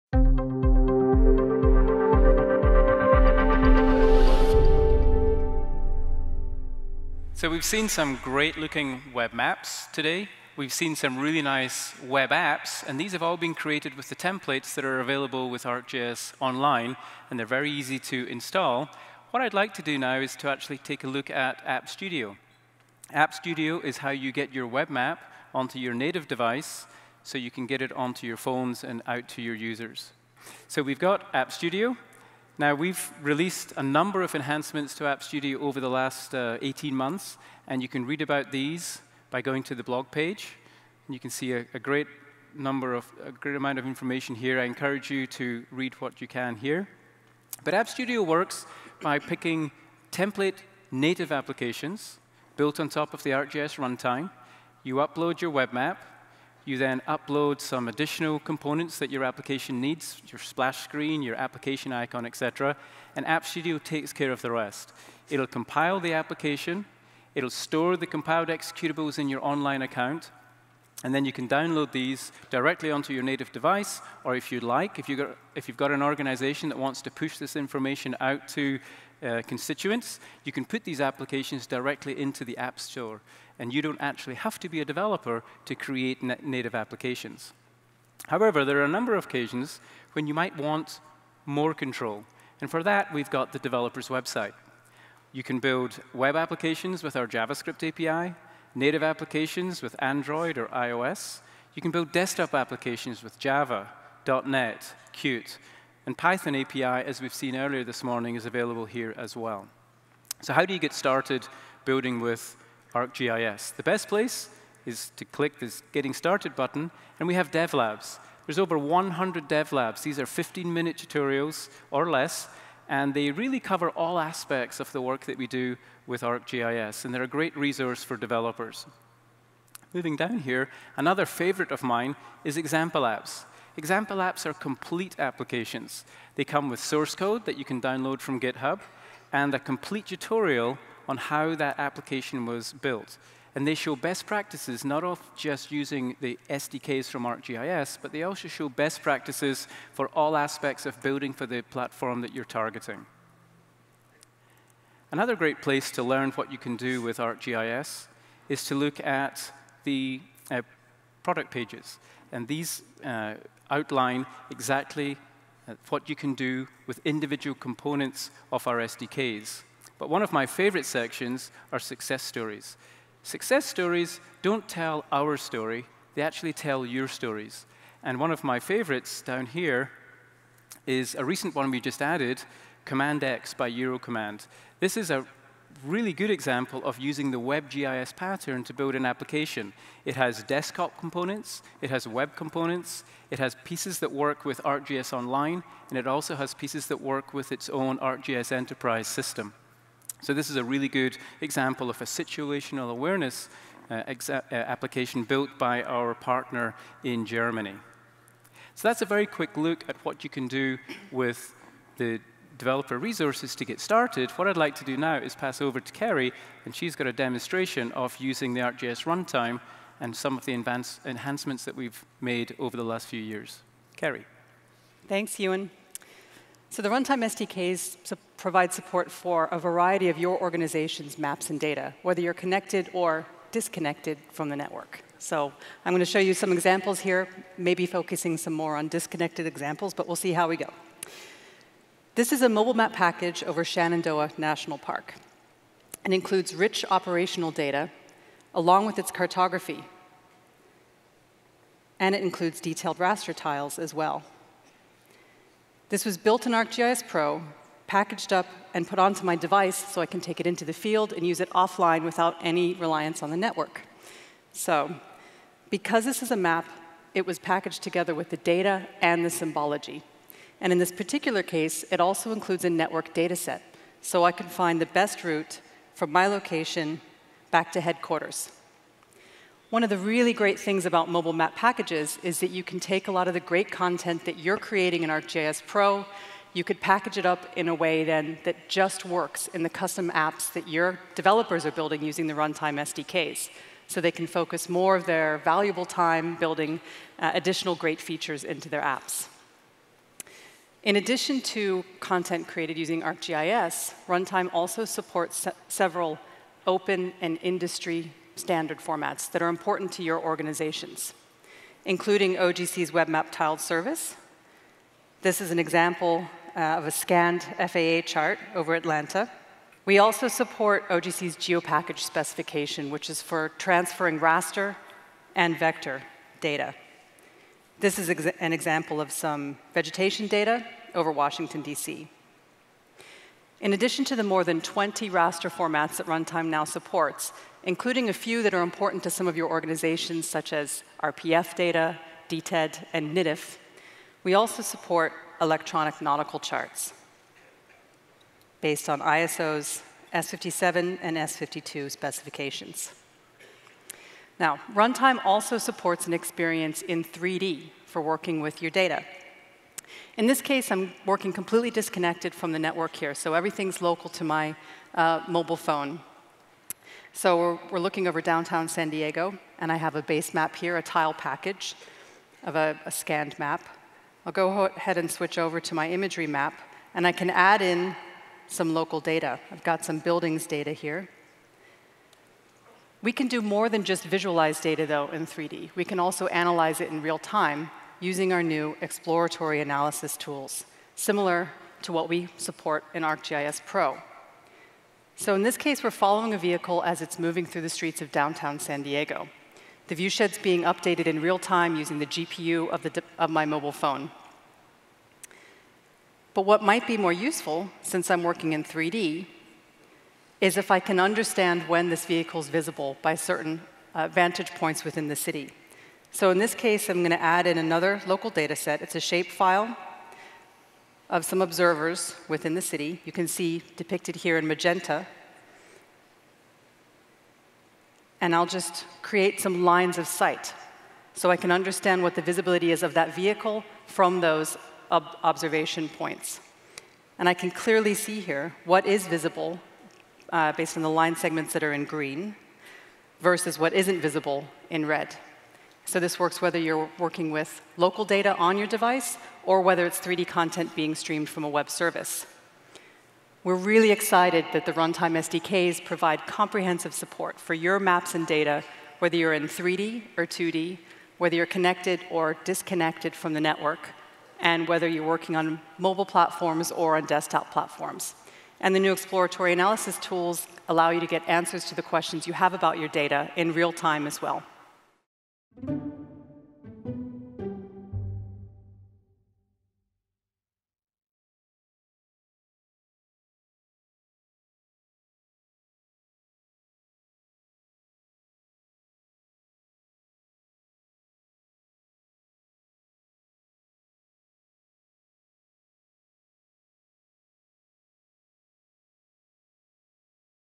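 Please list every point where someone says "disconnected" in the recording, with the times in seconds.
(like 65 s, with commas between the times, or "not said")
233 s, 238 s, 361 s, 462 s.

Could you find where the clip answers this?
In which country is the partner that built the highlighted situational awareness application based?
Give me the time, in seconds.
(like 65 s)
207 s.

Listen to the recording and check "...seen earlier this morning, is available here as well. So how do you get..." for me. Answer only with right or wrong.
right.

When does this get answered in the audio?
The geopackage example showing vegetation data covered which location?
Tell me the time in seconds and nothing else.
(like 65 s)
331 s.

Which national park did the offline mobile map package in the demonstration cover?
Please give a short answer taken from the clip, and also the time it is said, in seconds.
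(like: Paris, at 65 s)
Shenandoah National Park, at 243 s.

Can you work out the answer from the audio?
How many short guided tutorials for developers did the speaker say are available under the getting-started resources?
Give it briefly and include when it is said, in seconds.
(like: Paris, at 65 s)
over 100, at 118 s.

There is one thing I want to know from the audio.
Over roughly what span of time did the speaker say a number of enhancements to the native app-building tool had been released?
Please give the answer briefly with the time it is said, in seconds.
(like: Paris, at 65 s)
18 months, at 36 s.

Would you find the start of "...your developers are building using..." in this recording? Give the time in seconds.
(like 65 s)
290 s.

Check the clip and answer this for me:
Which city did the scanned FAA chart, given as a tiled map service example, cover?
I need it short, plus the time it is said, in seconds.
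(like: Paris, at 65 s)
Atlanta, at 318 s.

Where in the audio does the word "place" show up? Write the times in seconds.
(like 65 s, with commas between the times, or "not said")
114 s, 155 s.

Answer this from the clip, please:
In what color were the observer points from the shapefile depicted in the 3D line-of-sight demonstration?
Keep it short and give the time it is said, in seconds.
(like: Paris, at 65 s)
magenta, at 424 s.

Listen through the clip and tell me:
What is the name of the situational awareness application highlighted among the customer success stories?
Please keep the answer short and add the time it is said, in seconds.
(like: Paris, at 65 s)
Command X, at 182 s.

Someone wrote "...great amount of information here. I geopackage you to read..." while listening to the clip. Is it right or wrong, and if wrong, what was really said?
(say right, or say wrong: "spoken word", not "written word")
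wrong: "encourage", not "geopackage".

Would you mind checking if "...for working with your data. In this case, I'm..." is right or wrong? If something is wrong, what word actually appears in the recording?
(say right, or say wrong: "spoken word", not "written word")
right.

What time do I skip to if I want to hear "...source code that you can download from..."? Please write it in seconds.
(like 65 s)
136 s.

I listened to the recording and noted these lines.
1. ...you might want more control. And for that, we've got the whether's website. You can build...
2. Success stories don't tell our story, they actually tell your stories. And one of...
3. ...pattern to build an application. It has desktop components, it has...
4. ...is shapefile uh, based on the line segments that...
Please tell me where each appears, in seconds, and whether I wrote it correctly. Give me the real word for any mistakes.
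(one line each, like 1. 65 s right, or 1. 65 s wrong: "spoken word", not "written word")
1. 90 s wrong: "developer", not "whether"
2. 173 s right
3. 188 s right
4. 438 s wrong: "visible", not "shapefile".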